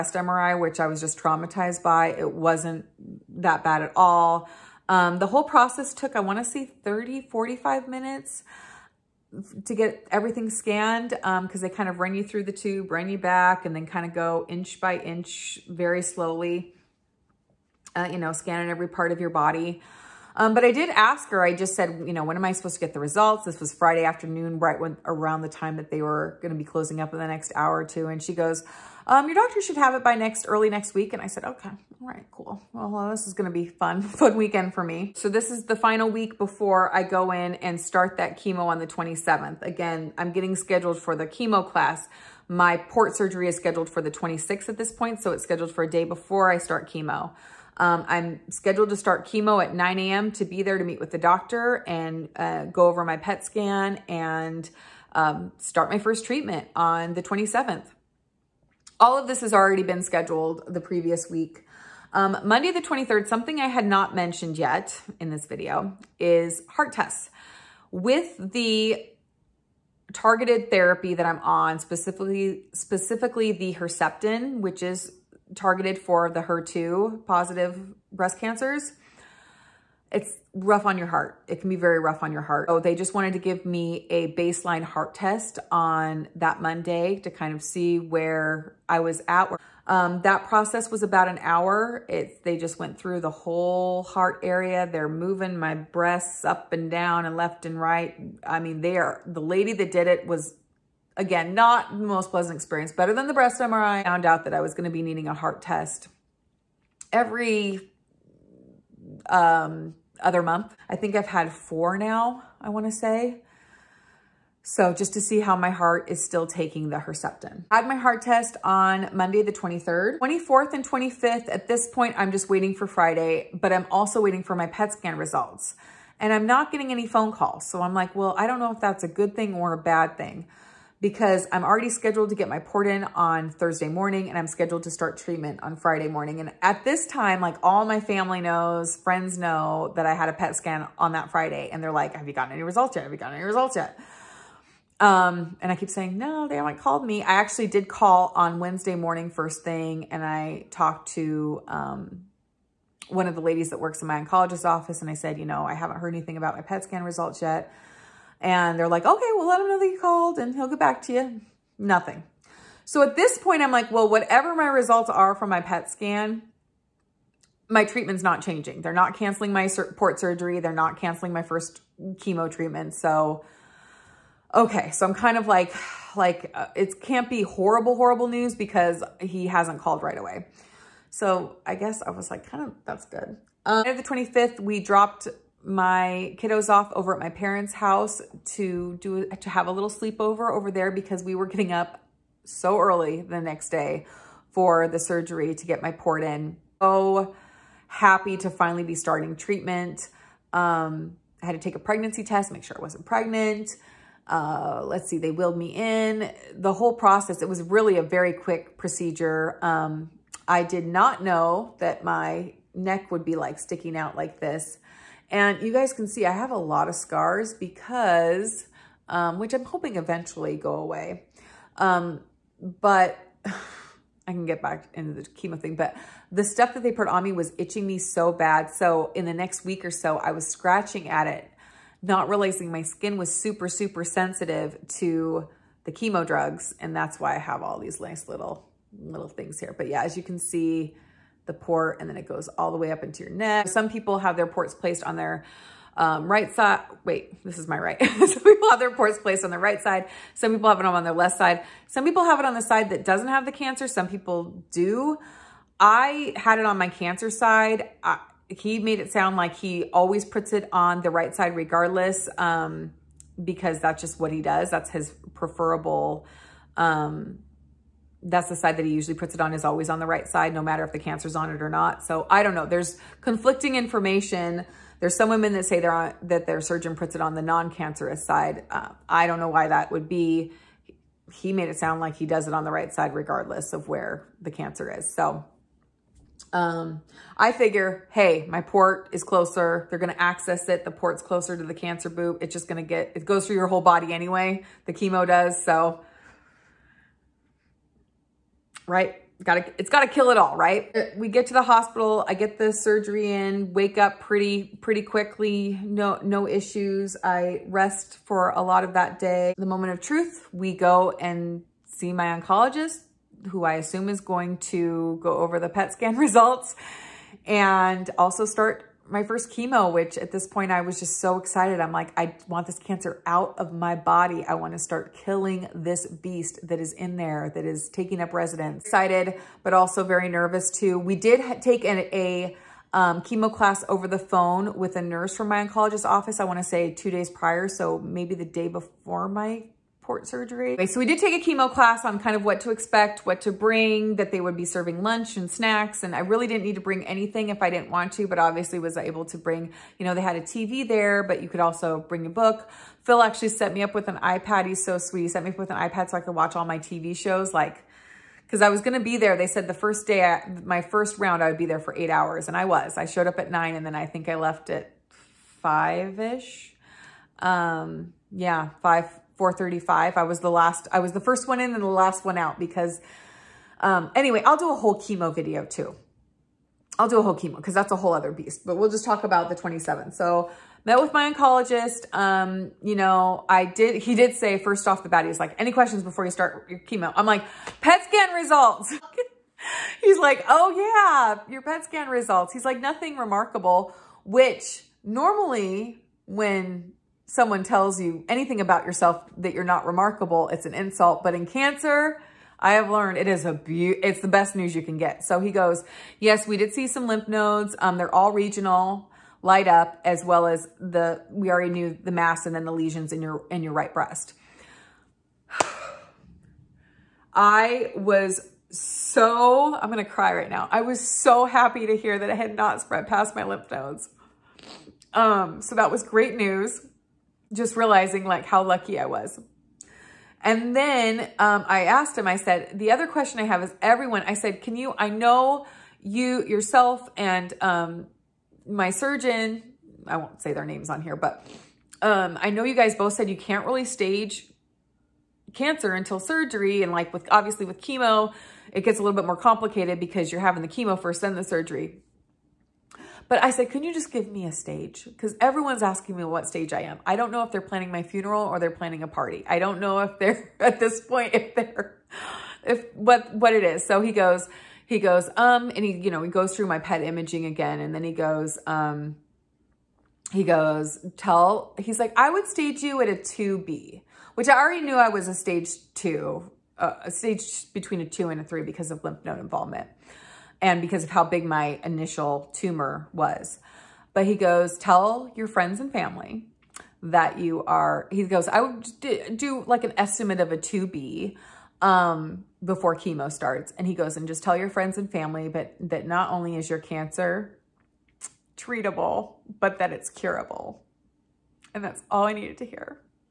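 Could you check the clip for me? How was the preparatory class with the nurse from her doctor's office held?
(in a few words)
Over the phone.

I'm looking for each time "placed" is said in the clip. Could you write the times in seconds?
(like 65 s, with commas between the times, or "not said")
244 s, 249 s.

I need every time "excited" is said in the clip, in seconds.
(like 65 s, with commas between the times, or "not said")
321 s, 328 s.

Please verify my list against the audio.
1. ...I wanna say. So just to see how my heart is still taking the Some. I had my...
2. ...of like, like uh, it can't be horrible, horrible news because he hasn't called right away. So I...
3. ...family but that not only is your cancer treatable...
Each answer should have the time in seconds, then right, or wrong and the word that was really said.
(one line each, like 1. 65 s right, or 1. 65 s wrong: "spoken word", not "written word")
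1. 112 s wrong: "Herceptin", not "Some"
2. 175 s right
3. 495 s right.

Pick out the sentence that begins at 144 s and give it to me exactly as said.
Um, and I keep saying, no, they haven't called me.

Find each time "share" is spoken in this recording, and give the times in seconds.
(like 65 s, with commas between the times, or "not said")
not said.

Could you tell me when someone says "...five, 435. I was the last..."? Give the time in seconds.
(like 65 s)
368 s.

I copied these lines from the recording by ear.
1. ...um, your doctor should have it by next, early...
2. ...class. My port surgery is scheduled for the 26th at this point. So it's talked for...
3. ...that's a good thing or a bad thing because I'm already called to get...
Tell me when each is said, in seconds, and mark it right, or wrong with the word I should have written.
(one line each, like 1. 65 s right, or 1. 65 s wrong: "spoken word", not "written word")
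1. 29 s right
2. 41 s wrong: "scheduled", not "talked"
3. 128 s wrong: "scheduled", not "called".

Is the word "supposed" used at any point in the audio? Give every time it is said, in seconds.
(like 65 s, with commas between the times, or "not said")
22 s.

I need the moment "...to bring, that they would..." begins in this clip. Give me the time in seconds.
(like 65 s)
343 s.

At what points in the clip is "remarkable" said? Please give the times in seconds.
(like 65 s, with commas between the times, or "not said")
393 s, 399 s.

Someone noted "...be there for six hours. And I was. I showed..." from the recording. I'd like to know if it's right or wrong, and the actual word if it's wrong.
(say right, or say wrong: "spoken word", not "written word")
wrong: "eight", not "six".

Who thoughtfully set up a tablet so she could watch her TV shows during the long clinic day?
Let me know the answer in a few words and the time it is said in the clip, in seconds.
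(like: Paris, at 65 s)
Phil, at 353 s.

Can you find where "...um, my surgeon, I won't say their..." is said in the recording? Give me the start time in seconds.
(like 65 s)
437 s.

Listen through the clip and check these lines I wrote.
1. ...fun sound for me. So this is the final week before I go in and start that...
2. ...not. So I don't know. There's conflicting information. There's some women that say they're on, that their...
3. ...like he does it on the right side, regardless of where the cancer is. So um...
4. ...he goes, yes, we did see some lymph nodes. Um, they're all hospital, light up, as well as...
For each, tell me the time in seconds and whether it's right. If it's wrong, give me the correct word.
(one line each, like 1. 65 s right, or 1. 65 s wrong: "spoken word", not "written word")
1. 34 s wrong: "weekend", not "sound"
2. 271 s right
3. 282 s right
4. 405 s wrong: "regional", not "hospital".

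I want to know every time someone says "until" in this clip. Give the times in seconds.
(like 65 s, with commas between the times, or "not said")
445 s.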